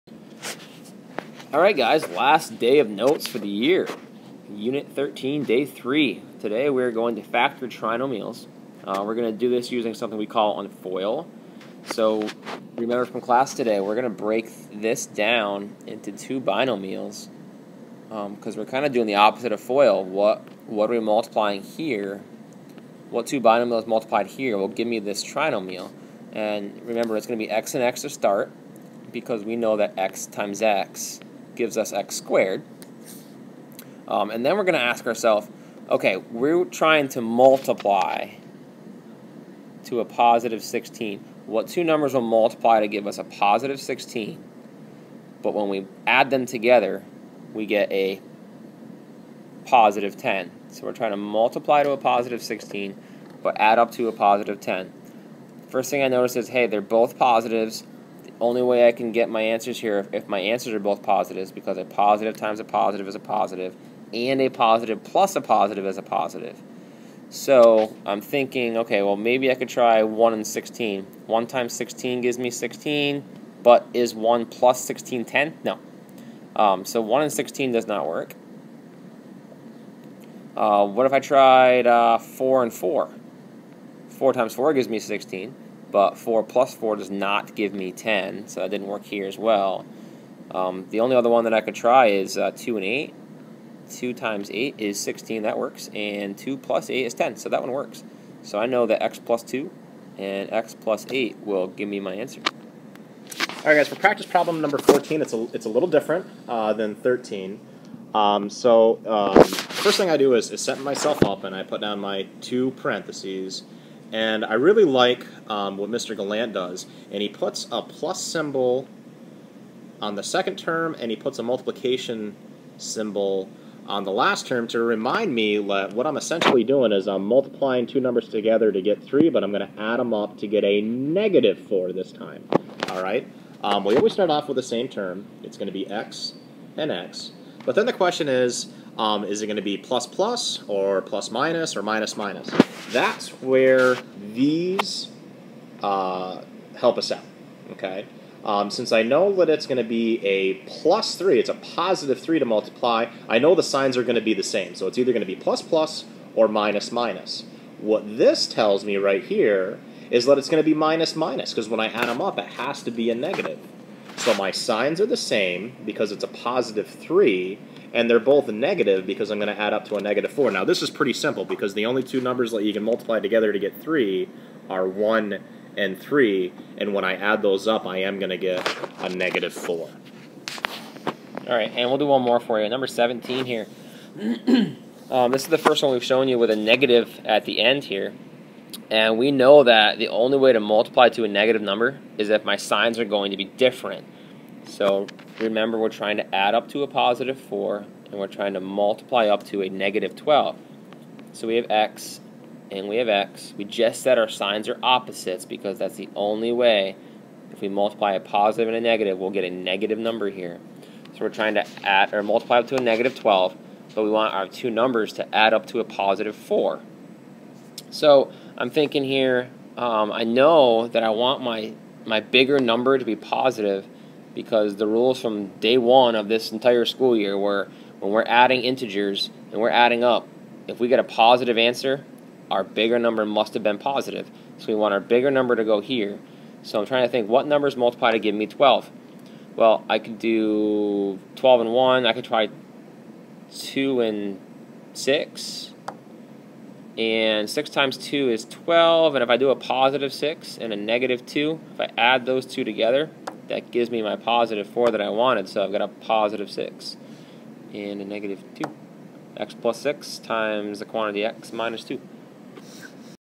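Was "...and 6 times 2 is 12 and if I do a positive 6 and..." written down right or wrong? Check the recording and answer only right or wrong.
right.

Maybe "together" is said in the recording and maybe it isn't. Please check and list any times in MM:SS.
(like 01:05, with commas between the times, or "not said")
00:46, 02:08, 02:53, 04:12.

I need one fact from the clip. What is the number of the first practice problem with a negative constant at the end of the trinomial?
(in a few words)
17.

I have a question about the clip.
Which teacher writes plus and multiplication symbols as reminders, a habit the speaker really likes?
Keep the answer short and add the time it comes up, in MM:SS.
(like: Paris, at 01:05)
Mr. Gallant, at 01:55.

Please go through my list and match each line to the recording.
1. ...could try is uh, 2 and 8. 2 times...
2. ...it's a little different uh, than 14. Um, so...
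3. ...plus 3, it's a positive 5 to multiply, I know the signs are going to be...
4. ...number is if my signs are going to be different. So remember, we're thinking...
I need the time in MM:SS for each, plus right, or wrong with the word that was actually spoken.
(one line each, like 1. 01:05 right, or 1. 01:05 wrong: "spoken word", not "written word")
1. 01:31 right
2. 01:45 wrong: "13", not "14"
3. 02:30 wrong: "3", not "5"
4. 03:11 wrong: "trying", not "thinking".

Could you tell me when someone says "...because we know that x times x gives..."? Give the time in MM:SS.
00:29.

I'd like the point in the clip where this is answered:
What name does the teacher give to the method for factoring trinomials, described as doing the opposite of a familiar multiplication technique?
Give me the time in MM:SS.
00:10.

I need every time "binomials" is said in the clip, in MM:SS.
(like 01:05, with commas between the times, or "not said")
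00:16, 00:23.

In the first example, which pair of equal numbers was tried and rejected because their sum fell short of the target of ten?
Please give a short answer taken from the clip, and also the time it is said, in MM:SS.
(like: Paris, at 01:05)
4 and 4, at 01:22.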